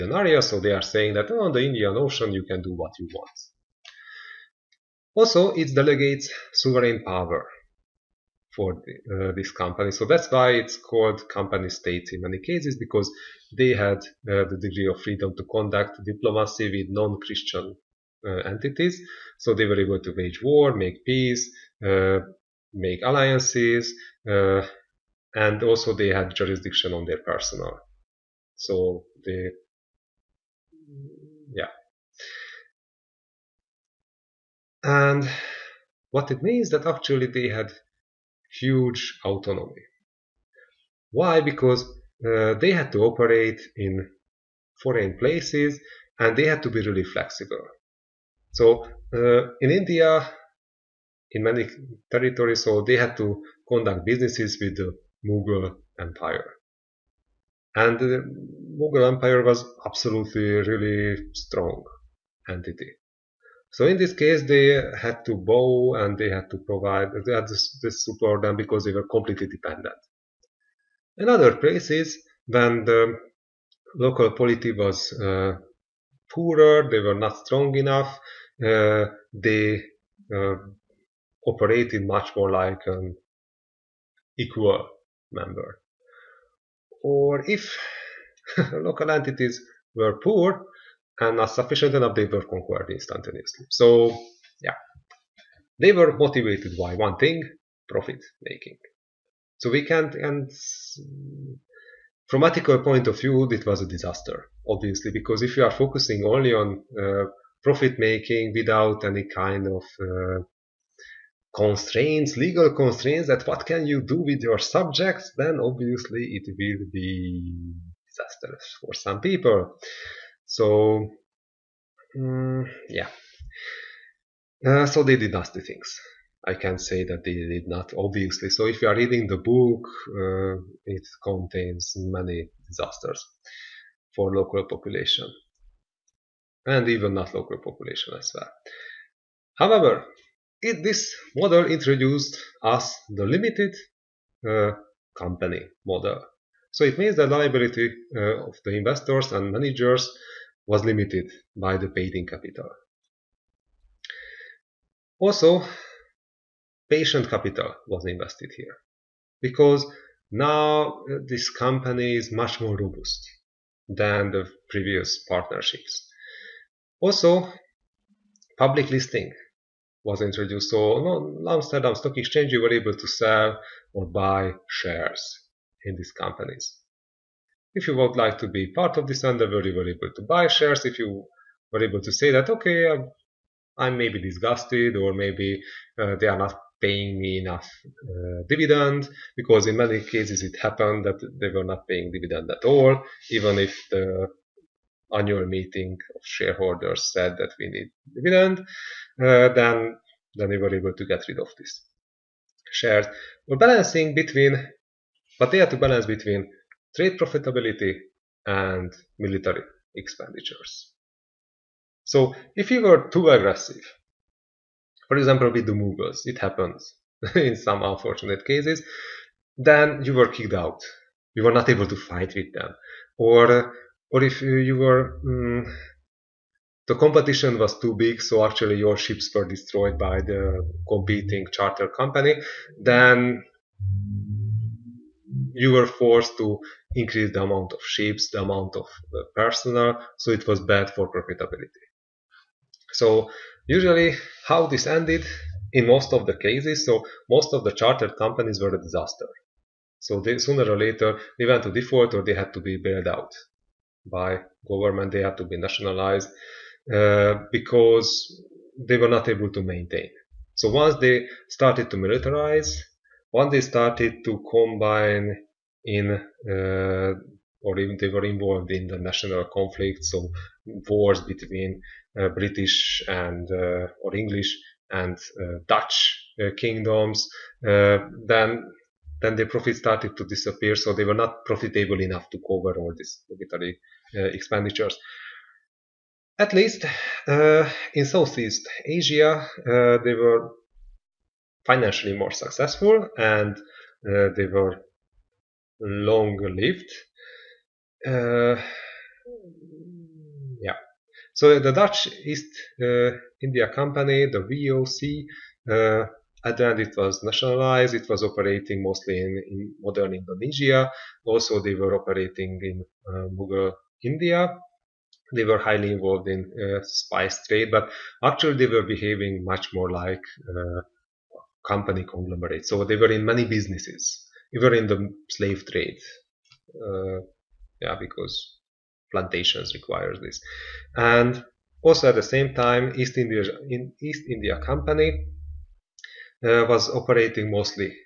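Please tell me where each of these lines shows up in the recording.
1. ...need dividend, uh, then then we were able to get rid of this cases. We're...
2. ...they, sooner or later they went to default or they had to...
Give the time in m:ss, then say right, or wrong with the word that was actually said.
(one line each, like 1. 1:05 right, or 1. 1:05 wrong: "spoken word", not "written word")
1. 3:17 wrong: "shares", not "cases"
2. 4:10 right.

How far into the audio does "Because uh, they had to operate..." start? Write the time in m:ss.
0:41.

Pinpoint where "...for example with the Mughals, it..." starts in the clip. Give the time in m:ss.
3:35.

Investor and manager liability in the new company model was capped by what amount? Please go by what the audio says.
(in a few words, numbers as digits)
paid-in capital.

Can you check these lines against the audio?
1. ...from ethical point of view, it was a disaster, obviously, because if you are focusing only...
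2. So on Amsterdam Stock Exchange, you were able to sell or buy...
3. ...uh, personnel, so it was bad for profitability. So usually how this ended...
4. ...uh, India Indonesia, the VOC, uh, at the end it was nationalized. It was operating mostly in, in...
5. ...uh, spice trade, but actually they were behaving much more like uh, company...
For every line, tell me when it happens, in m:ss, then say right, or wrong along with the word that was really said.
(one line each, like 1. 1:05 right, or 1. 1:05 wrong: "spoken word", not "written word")
1. 1:42 right
2. 2:50 right
3. 3:58 right
4. 5:02 wrong: "Company", not "Indonesia"
5. 5:16 right.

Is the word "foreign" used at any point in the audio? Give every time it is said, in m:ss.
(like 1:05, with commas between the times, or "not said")
0:44.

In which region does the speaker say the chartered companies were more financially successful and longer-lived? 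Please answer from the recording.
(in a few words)
Southeast Asia.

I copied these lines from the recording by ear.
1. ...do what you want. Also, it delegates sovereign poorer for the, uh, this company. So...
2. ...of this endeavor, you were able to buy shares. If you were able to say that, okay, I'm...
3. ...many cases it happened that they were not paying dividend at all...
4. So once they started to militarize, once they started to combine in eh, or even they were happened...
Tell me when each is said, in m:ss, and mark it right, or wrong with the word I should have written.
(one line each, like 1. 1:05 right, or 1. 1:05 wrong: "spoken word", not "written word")
1. 0:02 wrong: "power", not "poorer"
2. 2:58 right
3. 3:09 right
4. 4:20 wrong: "involved", not "happened".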